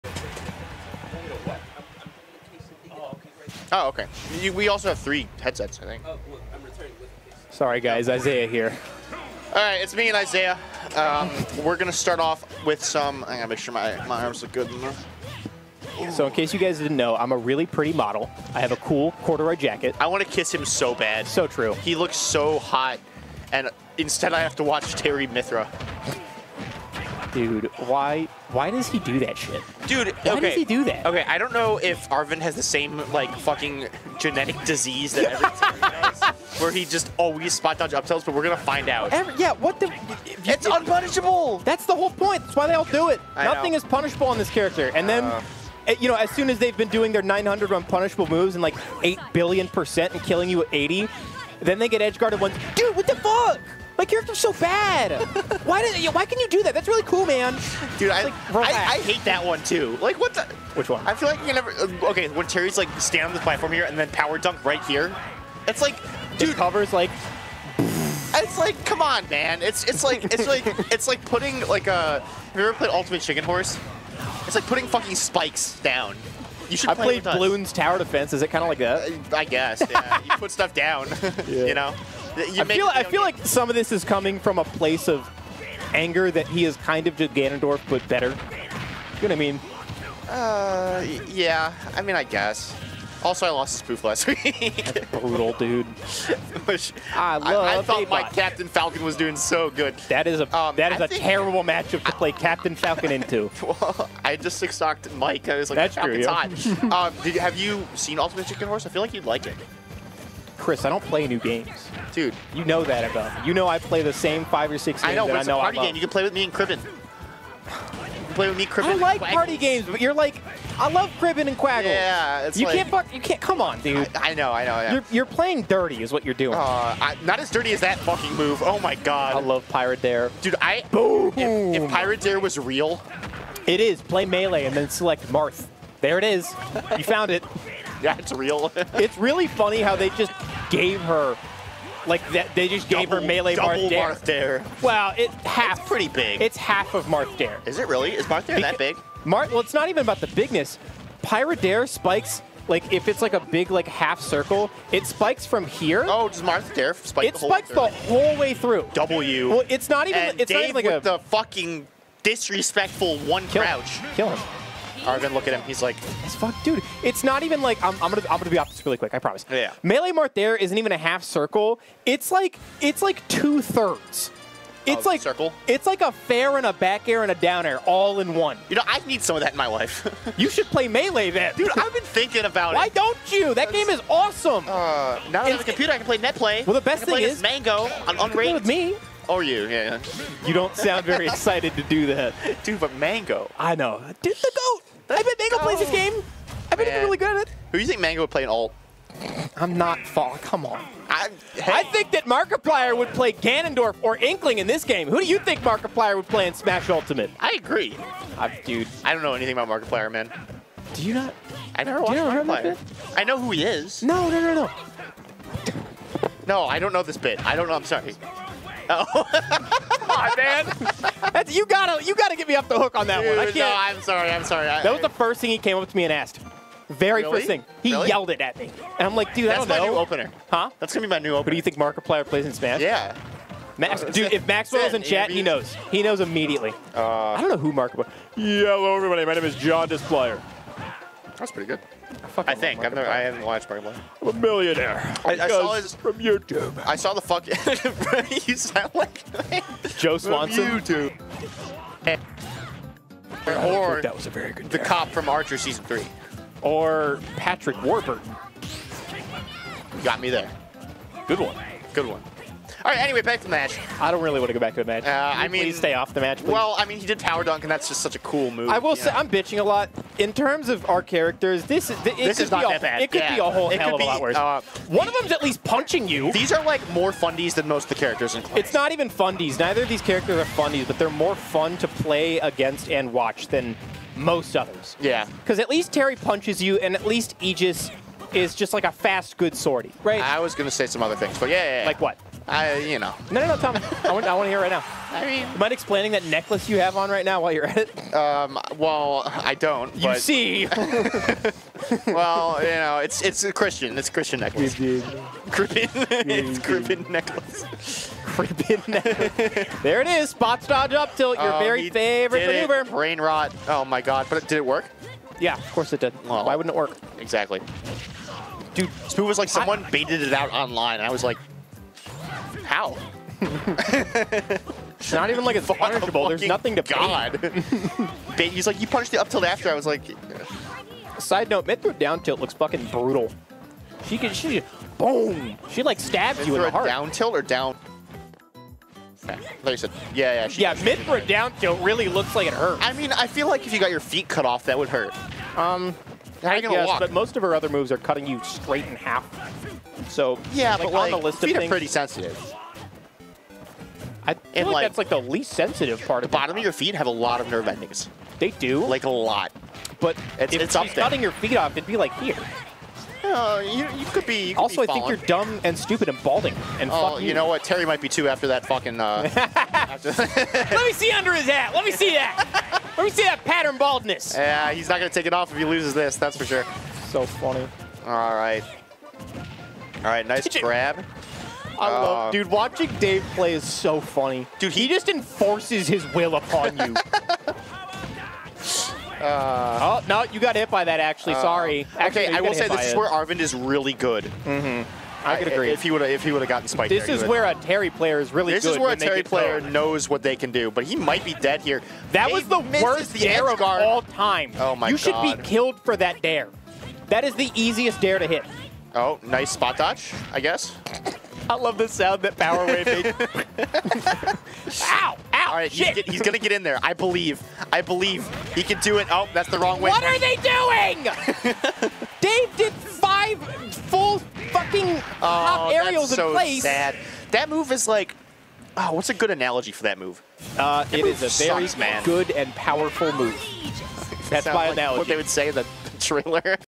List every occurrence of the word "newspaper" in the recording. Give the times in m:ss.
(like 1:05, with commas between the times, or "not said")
not said.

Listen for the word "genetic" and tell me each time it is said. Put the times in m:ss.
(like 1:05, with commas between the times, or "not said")
0:34.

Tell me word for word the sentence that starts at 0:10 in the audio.
Um, we're going to start off with some...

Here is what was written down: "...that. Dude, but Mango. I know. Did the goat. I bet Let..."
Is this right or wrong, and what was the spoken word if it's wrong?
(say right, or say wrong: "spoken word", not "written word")
wrong: "Mango", not "Let".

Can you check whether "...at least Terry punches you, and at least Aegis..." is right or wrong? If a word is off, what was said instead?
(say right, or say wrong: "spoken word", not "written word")
right.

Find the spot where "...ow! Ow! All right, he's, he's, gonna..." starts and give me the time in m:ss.
6:54.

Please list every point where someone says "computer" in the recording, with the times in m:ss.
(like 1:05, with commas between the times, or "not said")
3:05.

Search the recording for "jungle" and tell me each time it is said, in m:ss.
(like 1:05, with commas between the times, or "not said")
not said.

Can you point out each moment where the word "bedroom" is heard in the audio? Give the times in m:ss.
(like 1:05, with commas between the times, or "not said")
not said.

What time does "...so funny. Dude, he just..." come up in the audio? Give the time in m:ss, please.
6:23.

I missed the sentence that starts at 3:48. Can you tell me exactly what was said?
And I'm like, dude, That's I don't know.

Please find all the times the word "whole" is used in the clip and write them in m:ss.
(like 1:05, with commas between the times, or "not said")
0:41, 2:37, 4:33.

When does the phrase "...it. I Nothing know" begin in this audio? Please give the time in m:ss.
0:43.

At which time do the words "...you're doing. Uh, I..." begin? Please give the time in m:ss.
2:06.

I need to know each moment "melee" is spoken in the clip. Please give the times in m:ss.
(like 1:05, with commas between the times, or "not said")
2:14, 2:23, 2:49, 3:00.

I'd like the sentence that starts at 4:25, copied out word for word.
Uh, I mean, stay off the match.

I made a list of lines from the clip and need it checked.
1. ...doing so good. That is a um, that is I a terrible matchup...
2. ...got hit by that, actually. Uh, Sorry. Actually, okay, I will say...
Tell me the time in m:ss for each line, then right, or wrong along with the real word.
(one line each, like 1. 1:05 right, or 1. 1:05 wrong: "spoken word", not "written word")
1. 1:39 right
2. 6:30 right.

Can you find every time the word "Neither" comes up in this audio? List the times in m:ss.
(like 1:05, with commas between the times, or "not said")
4:39.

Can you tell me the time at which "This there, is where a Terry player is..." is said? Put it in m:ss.
6:36.